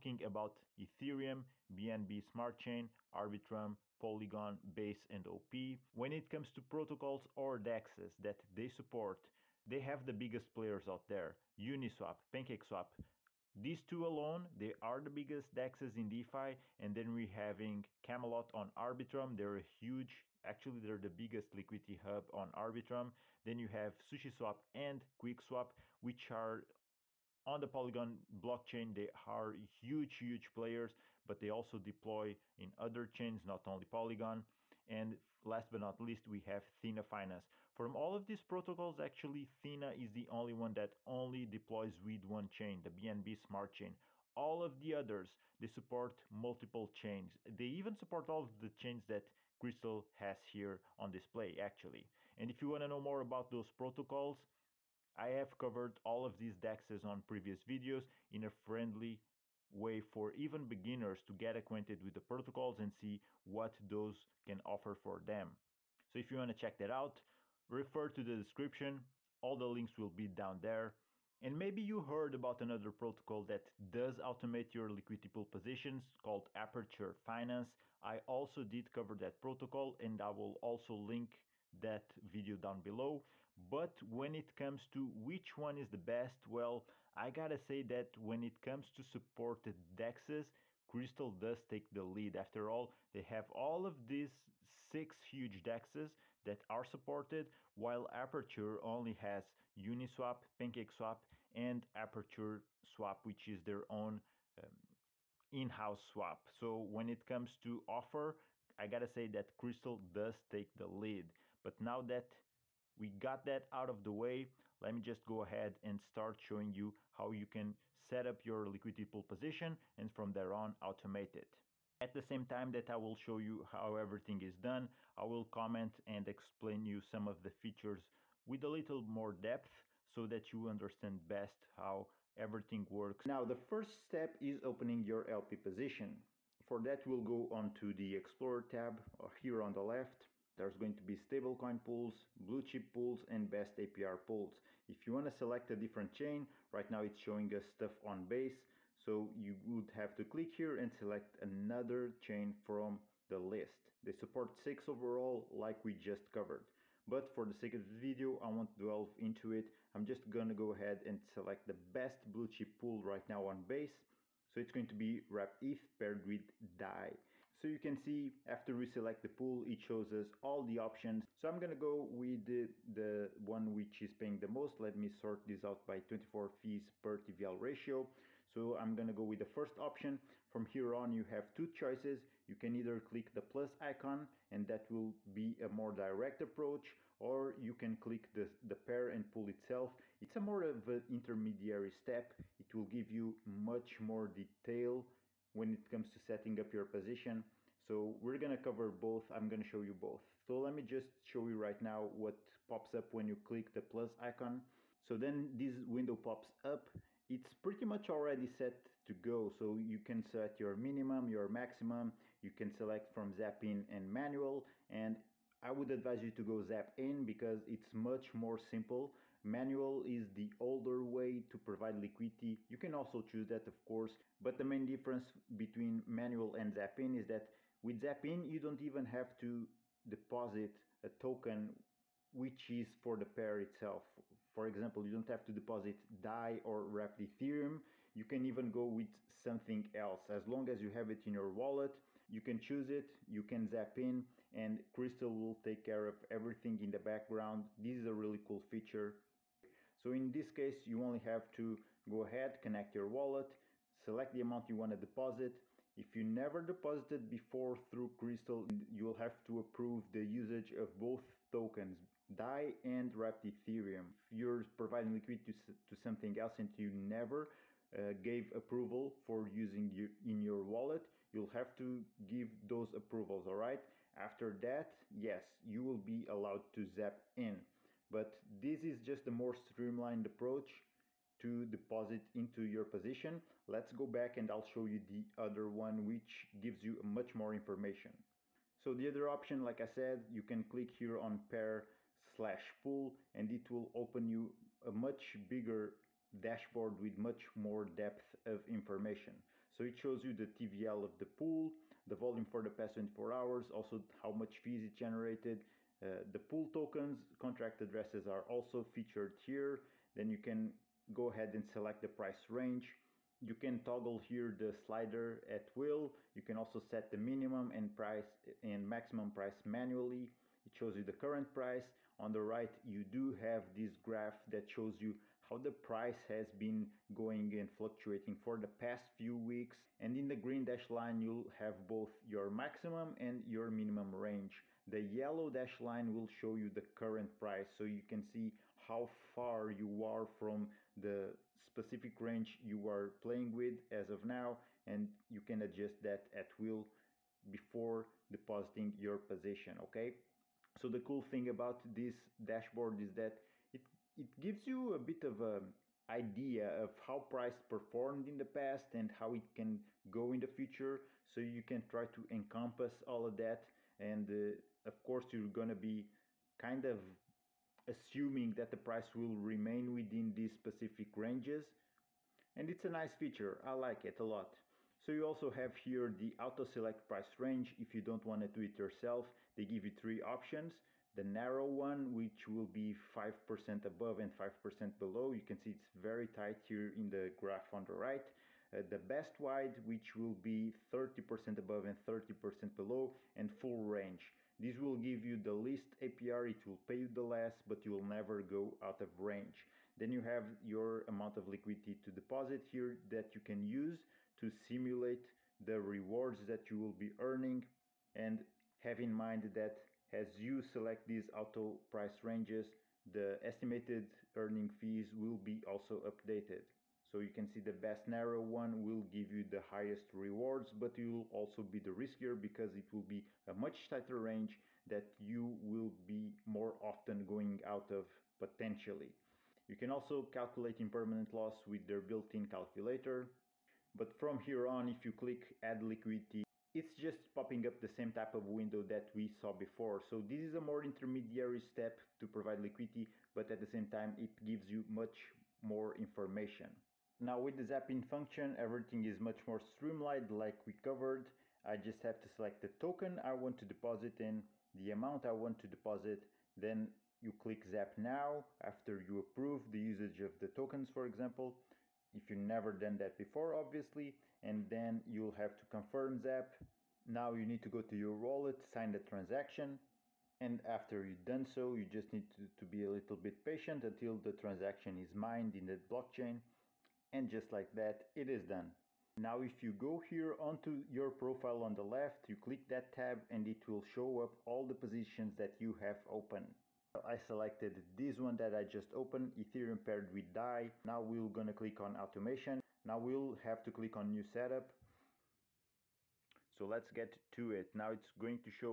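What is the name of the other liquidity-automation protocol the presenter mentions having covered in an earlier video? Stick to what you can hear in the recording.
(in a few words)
Aperture Finance.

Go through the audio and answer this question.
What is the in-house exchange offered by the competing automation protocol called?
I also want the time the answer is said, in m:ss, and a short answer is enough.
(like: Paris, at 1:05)
Aperture Swap, at 1:41.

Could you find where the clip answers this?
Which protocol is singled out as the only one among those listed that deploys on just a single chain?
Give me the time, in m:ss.
0:36.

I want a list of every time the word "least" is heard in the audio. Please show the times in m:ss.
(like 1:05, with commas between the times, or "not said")
0:36, 6:35.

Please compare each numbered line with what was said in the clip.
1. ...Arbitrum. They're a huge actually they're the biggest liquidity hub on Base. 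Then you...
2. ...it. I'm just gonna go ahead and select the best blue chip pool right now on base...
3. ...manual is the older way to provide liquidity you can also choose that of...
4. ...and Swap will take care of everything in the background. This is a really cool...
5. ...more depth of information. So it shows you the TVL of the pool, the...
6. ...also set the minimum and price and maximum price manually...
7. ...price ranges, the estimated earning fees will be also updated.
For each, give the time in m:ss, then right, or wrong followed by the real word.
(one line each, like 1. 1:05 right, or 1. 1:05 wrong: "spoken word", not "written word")
1. 0:18 wrong: "Arbitrum", not "Base"
2. 2:39 right
3. 3:39 right
4. 4:04 wrong: "Krystal", not "Swap"
5. 4:57 right
6. 5:16 right
7. 6:51 right.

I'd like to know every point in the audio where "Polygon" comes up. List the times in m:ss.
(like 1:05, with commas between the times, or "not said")
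0:03, 0:27, 0:33.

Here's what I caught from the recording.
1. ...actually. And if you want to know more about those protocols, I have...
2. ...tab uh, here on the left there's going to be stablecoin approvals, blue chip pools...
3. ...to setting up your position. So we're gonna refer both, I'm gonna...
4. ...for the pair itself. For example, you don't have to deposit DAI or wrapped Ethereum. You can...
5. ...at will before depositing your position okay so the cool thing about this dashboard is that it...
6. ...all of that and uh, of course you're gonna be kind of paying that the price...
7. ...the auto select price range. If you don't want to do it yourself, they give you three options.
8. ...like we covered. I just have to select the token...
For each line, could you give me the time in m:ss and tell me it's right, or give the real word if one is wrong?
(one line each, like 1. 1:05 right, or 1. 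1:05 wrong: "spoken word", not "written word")
1. 0:51 right
2. 2:18 wrong: "pools", not "approvals"
3. 3:16 wrong: "cover", not "refer"
4. 3:53 right
5. 5:46 right
6. 6:03 wrong: "assuming", not "paying"
7. 6:16 right
8. 7:30 right.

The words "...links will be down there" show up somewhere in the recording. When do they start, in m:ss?
1:09.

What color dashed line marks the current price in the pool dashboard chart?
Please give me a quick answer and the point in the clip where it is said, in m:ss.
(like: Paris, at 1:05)
Yellow, at 5:35.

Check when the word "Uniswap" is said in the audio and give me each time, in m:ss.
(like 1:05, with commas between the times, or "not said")
0:11, 1:39.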